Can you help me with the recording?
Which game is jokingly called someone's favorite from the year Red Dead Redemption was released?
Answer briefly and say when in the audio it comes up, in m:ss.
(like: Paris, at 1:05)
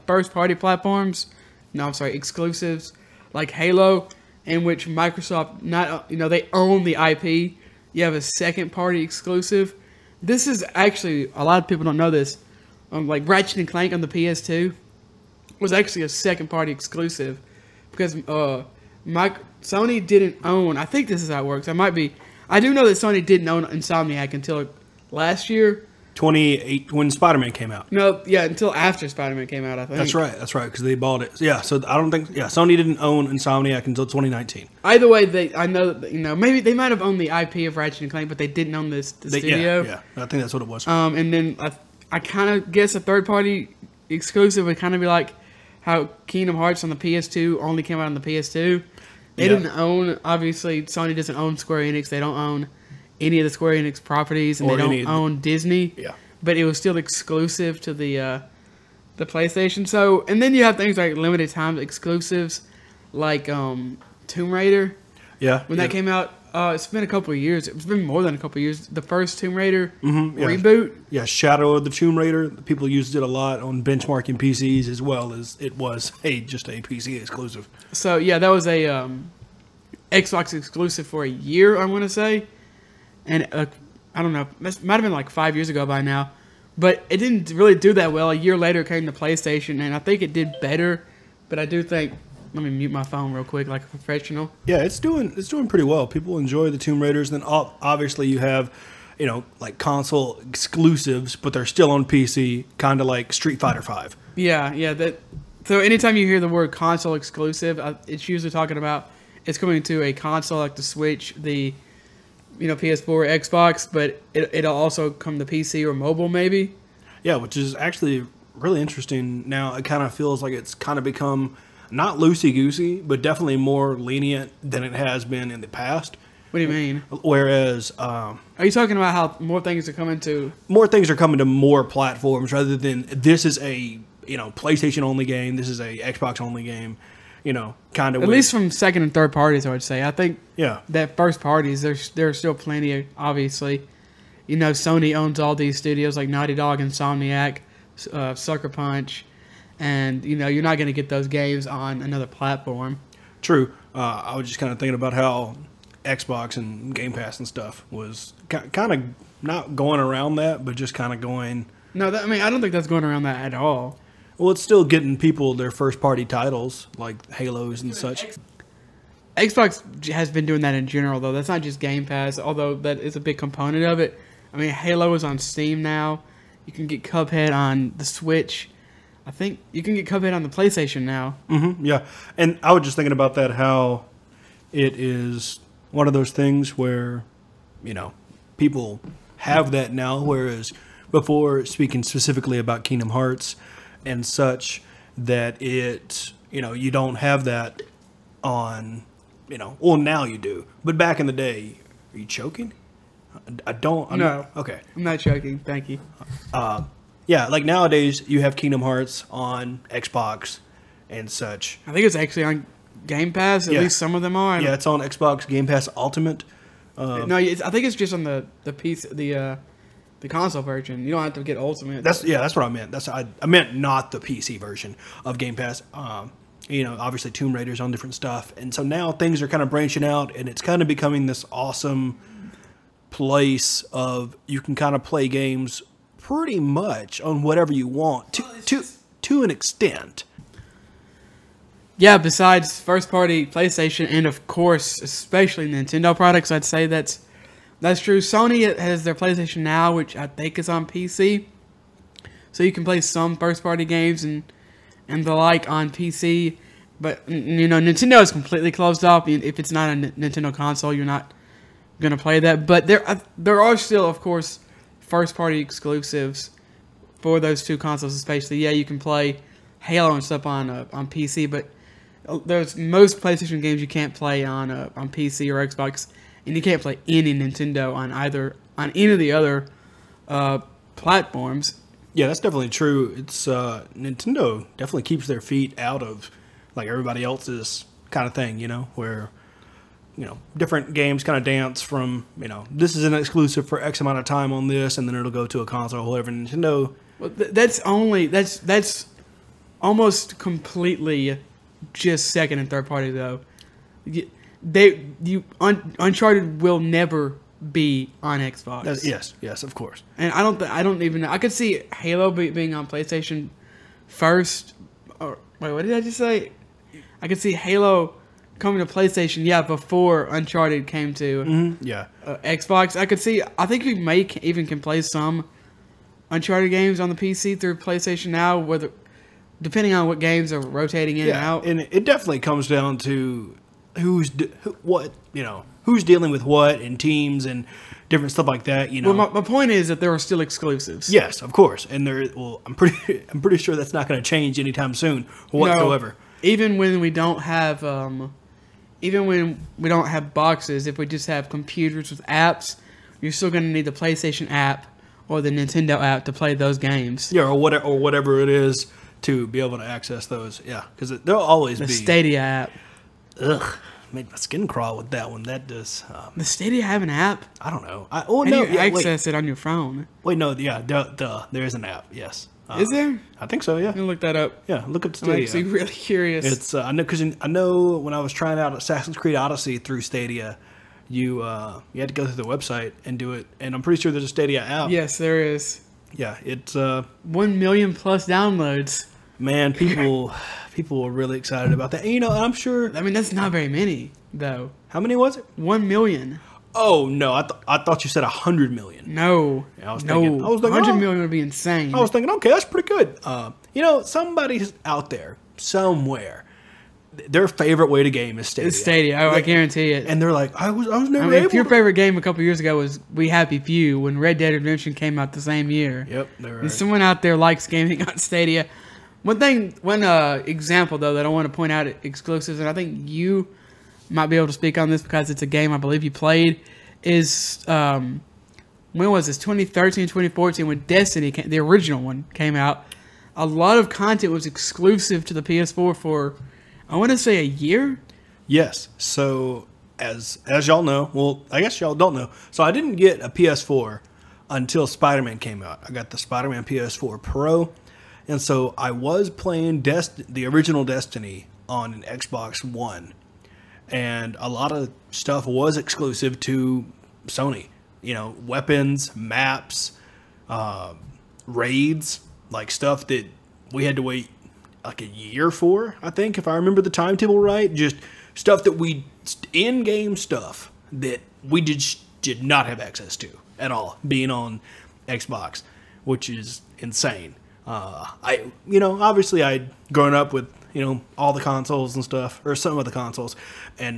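We Happy Few, at 6:53.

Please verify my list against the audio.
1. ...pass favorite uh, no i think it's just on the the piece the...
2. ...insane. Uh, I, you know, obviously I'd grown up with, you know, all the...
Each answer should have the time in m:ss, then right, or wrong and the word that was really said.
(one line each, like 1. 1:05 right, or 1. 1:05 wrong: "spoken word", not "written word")
1. 3:35 wrong: "ultimate", not "favorite"
2. 7:56 right.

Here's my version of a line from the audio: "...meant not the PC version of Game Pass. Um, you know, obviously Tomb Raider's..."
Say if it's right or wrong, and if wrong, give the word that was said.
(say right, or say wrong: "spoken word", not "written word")
right.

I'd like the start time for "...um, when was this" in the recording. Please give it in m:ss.
7:07.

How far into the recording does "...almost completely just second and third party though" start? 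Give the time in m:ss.
4:59.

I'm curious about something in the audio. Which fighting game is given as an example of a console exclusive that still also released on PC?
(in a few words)
Street Fighter Five.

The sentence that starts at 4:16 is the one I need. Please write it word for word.
But you know, Nintendo is completely closed off.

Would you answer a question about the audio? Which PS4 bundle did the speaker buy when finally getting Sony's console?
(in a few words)
Spider Man PS4 Pro.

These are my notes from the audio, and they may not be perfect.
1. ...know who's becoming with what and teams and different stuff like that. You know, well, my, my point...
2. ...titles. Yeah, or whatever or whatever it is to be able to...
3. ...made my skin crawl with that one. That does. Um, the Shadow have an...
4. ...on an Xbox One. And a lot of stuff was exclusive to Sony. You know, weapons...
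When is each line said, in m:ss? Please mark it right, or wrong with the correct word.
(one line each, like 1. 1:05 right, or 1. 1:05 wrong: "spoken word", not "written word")
1. 5:35 wrong: "dealing", not "becoming"
2. 5:56 wrong: "games", not "titles"
3. 6:04 wrong: "Stadia", not "Shadow"
4. 7:31 right.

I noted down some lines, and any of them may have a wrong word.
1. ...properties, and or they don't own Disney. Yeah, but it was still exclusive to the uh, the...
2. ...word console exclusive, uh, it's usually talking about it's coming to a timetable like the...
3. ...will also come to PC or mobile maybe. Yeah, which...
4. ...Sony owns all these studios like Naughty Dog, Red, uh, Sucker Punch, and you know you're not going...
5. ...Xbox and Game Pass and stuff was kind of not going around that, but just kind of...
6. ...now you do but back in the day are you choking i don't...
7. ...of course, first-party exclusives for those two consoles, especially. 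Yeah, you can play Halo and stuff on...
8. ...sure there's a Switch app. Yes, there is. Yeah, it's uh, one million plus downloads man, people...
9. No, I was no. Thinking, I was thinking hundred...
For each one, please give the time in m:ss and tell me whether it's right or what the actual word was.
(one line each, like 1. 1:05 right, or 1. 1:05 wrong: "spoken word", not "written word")
1. 0:54 right
2. 1:46 wrong: "console", not "timetable"
3. 1:54 right
4. 2:24 wrong: "Insomniac", not "Red"
5. 2:36 right
6. 3:19 right
7. 4:24 right
8. 6:23 wrong: "Stadia", not "Switch"
9. 6:39 right.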